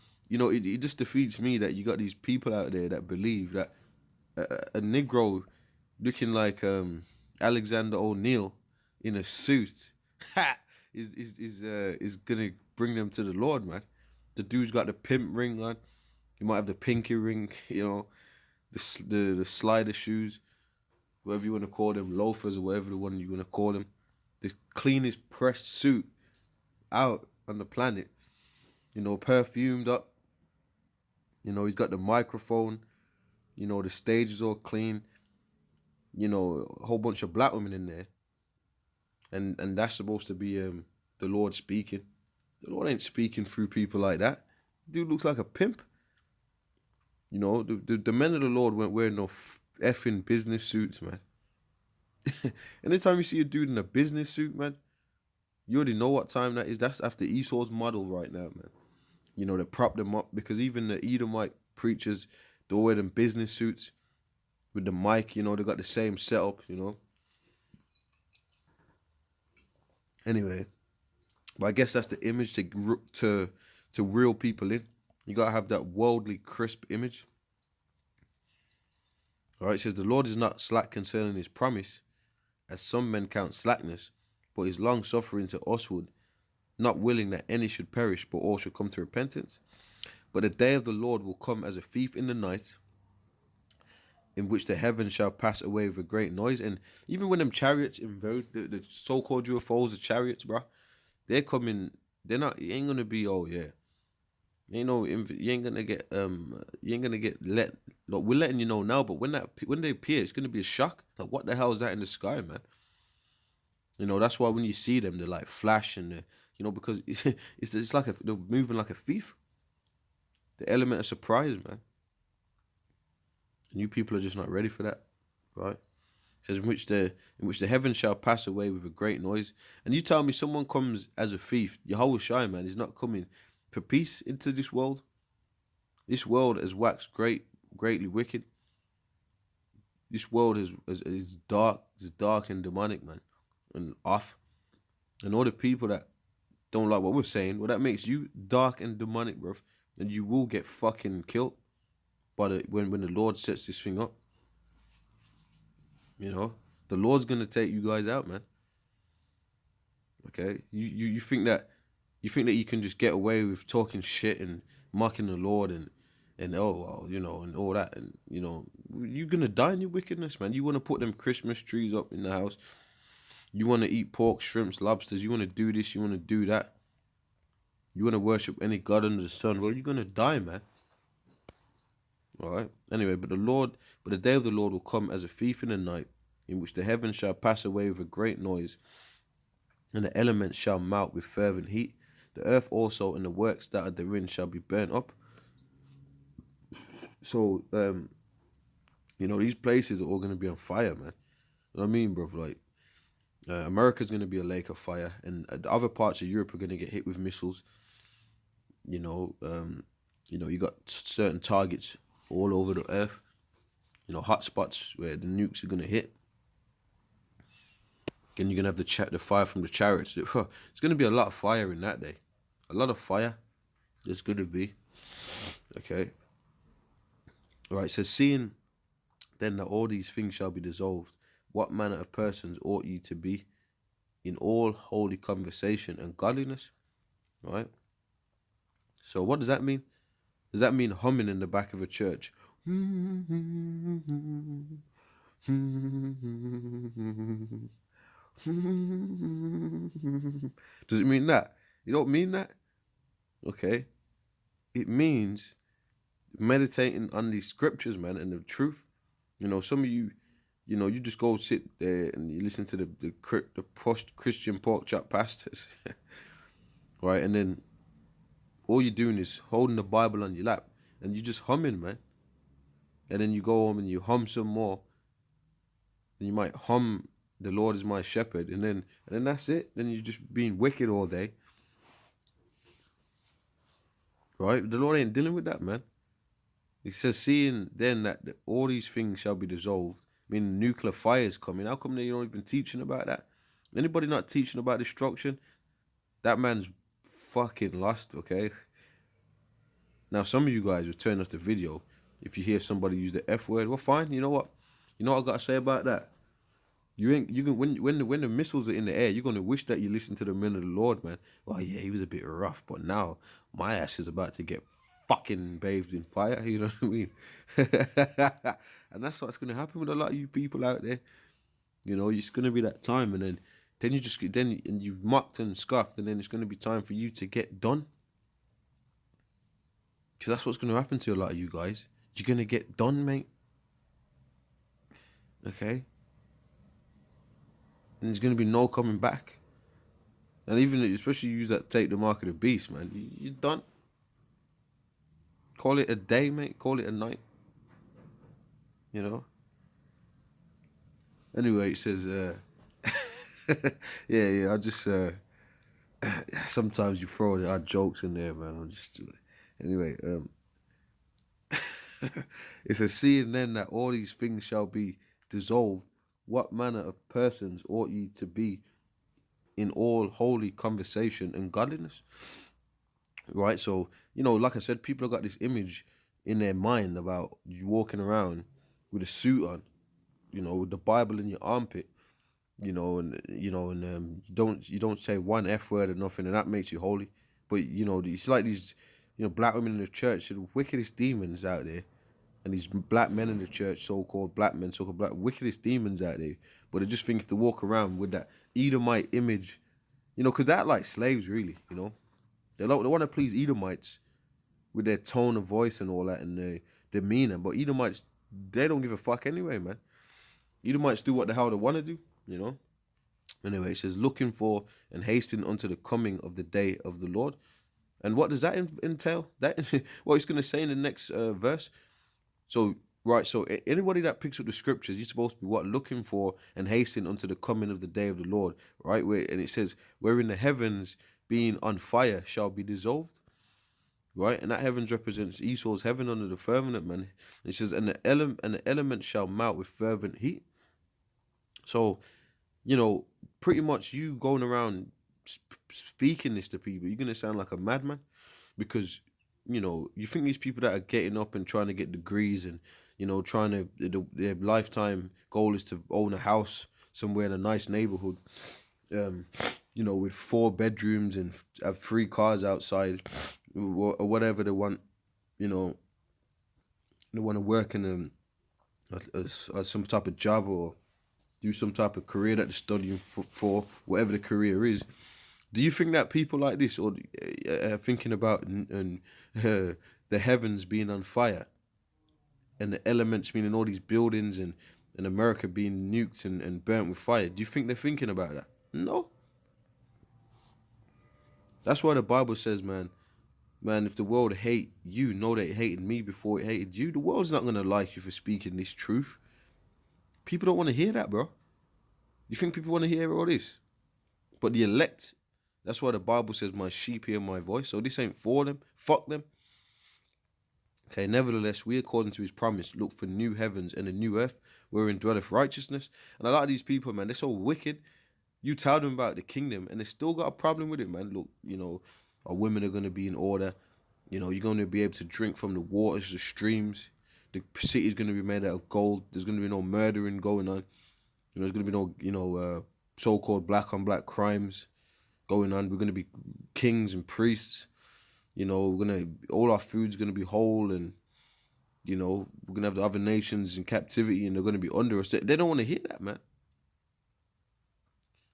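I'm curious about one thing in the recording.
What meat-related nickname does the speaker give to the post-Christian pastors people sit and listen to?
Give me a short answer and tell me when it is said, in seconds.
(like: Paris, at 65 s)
Pork chop pastors, at 264 s.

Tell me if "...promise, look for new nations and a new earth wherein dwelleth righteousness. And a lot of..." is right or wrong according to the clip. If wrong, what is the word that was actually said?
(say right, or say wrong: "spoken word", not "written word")
wrong: "heavens", not "nations".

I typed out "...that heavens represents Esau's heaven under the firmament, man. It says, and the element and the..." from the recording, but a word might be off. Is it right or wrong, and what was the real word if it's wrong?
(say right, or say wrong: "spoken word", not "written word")
right.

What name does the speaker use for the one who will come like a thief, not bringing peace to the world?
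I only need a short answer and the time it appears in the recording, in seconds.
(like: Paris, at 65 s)
Yahweh Shai, at 131 s.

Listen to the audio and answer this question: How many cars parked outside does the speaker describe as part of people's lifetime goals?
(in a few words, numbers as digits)
3.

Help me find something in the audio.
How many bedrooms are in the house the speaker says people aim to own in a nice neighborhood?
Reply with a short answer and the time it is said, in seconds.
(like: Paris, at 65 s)
4, at 460 s.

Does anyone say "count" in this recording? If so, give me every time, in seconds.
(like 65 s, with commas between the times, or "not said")
83 s.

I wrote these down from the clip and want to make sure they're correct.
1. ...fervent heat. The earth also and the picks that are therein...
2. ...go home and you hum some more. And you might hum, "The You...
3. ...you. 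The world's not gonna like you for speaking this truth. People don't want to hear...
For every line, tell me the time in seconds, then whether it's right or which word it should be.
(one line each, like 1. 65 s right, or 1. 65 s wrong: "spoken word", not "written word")
1. 191 s wrong: "works", not "picks"
2. 273 s wrong: "Lord", not "You"
3. 496 s right.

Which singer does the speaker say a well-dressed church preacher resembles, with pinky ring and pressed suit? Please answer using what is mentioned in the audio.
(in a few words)
Alexander O'Neal.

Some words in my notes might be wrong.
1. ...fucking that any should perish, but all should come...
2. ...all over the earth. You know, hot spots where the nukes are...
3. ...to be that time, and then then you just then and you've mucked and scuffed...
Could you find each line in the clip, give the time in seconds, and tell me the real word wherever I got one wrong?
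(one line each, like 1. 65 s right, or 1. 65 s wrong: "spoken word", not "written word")
1. 86 s wrong: "willing", not "fucking"
2. 212 s right
3. 322 s right.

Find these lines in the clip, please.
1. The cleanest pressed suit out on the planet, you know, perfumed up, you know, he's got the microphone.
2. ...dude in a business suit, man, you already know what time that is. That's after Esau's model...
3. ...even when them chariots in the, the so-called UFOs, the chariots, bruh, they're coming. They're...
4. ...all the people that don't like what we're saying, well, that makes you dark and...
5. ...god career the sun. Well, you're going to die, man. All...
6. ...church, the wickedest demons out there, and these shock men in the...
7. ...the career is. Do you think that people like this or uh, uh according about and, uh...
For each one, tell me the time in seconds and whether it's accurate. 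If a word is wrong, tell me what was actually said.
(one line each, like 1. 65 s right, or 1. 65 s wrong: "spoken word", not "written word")
1. 24 s right
2. 53 s right
3. 97 s right
4. 145 s right
5. 178 s wrong: "under", not "career"
6. 389 s wrong: "black", not "shock"
7. 474 s wrong: "thinking", not "according".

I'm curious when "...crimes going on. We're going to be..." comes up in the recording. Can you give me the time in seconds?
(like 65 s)
534 s.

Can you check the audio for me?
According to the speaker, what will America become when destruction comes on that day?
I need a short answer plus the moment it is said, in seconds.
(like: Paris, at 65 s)
A lake of fire, at 204 s.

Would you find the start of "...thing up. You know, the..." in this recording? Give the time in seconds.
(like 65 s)
153 s.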